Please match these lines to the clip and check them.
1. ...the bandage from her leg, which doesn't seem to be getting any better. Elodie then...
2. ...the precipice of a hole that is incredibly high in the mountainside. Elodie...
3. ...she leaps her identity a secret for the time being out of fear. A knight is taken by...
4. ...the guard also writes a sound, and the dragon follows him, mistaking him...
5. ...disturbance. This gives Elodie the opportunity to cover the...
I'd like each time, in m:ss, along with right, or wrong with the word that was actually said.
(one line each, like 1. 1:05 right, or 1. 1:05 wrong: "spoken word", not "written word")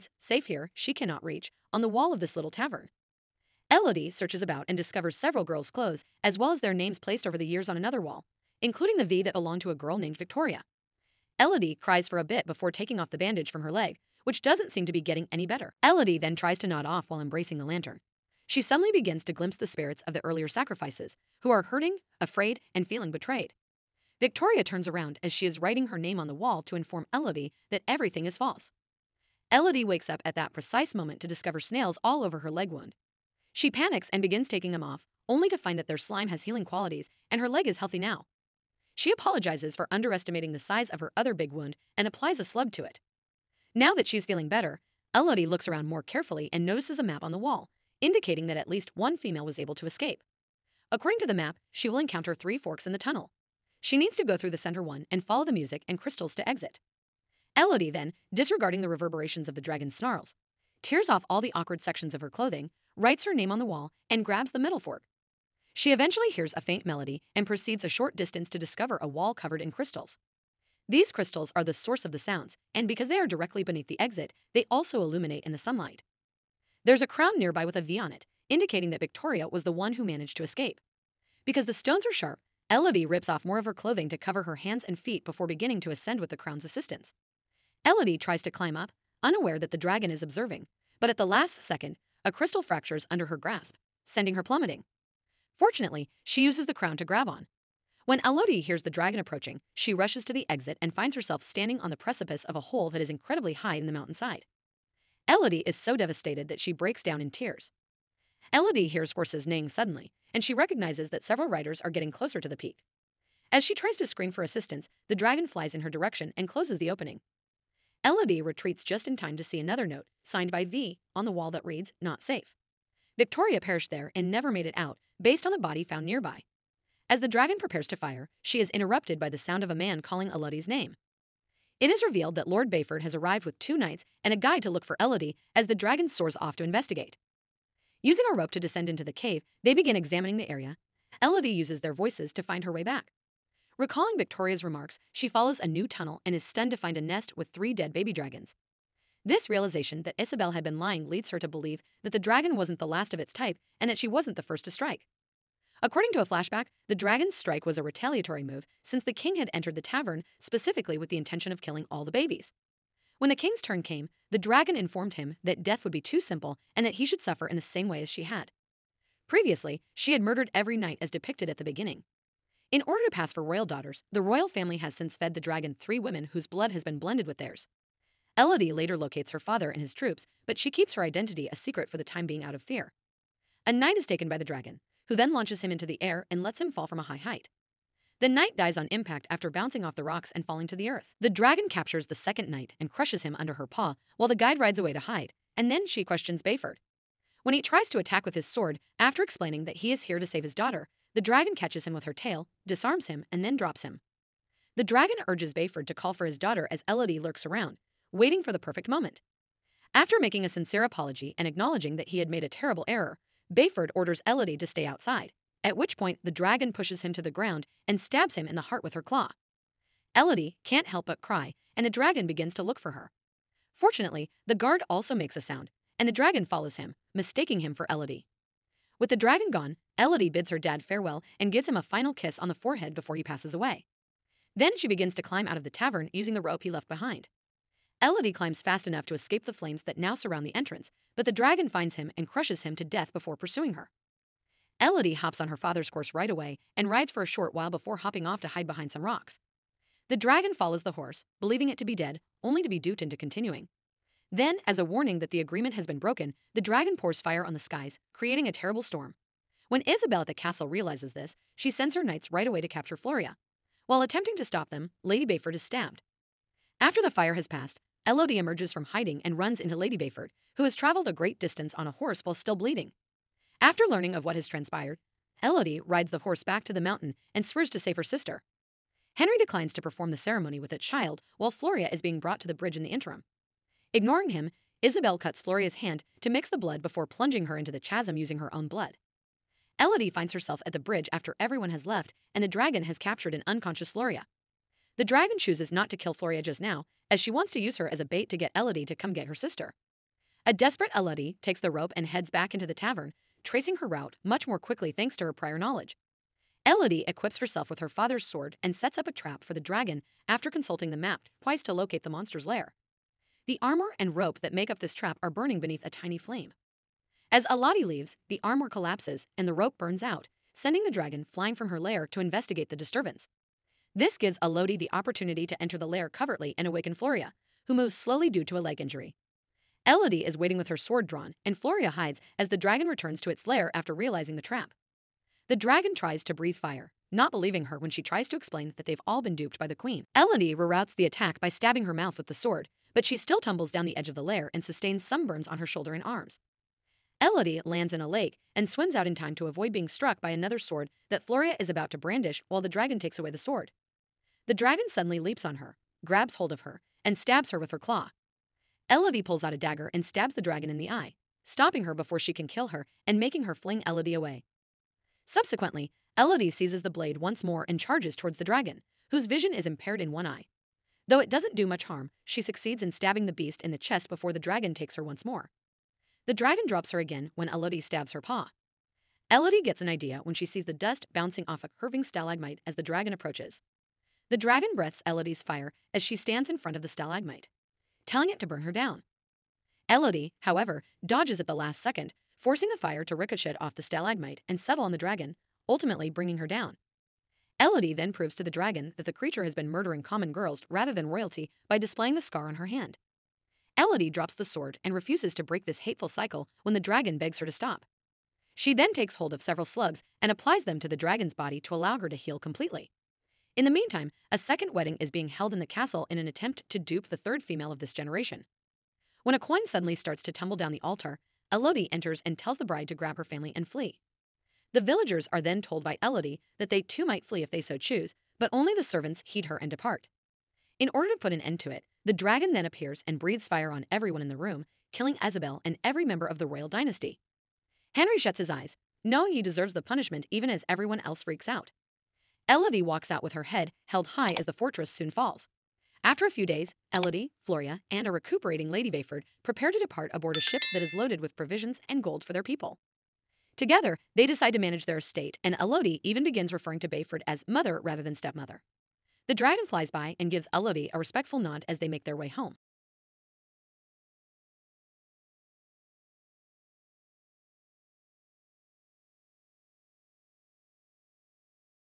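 1. 0:13 right
2. 1:41 right
3. 3:00 wrong: "keeps", not "leaps"
4. 3:44 wrong: "makes", not "writes"
5. 5:22 wrong: "enter", not "cover".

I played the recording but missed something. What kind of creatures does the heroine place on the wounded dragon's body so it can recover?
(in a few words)
Slugs.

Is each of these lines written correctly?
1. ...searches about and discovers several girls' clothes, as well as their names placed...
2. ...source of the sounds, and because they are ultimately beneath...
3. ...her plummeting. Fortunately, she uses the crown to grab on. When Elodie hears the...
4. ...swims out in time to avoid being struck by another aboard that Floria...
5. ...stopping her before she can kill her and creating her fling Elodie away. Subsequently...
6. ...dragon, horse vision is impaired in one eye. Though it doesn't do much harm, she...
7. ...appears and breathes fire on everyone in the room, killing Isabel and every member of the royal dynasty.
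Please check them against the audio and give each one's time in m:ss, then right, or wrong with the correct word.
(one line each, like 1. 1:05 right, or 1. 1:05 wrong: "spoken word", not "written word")
1. 0:04 right
2. 1:11 wrong: "directly", not "ultimately"
3. 1:34 right
4. 5:48 wrong: "sword", not "aboard"
5. 6:01 wrong: "making", not "creating"
6. 6:08 wrong: "whose", not "horse"
7. 7:12 right.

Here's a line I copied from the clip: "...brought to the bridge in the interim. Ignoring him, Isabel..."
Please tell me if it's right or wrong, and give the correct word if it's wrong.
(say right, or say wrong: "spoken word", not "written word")
right.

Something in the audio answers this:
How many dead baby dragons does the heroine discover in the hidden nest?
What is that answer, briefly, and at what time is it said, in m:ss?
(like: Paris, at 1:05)
3, at 2:27.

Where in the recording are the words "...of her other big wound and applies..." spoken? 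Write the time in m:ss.
0:40.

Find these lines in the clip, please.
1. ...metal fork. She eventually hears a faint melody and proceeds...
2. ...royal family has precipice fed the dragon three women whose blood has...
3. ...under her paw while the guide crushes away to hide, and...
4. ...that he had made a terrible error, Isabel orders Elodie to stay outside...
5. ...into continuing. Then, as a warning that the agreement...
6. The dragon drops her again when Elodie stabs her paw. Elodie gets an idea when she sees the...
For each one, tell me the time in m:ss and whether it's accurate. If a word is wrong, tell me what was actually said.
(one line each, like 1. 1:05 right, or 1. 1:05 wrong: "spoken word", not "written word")
1. 1:04 right
2. 2:54 wrong: "since", not "precipice"
3. 3:13 wrong: "rides", not "crushes"
4. 3:31 wrong: "Bayford", not "Isabel"
5. 4:13 right
6. 6:16 right.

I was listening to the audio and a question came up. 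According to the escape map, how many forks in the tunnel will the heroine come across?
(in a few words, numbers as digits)
3.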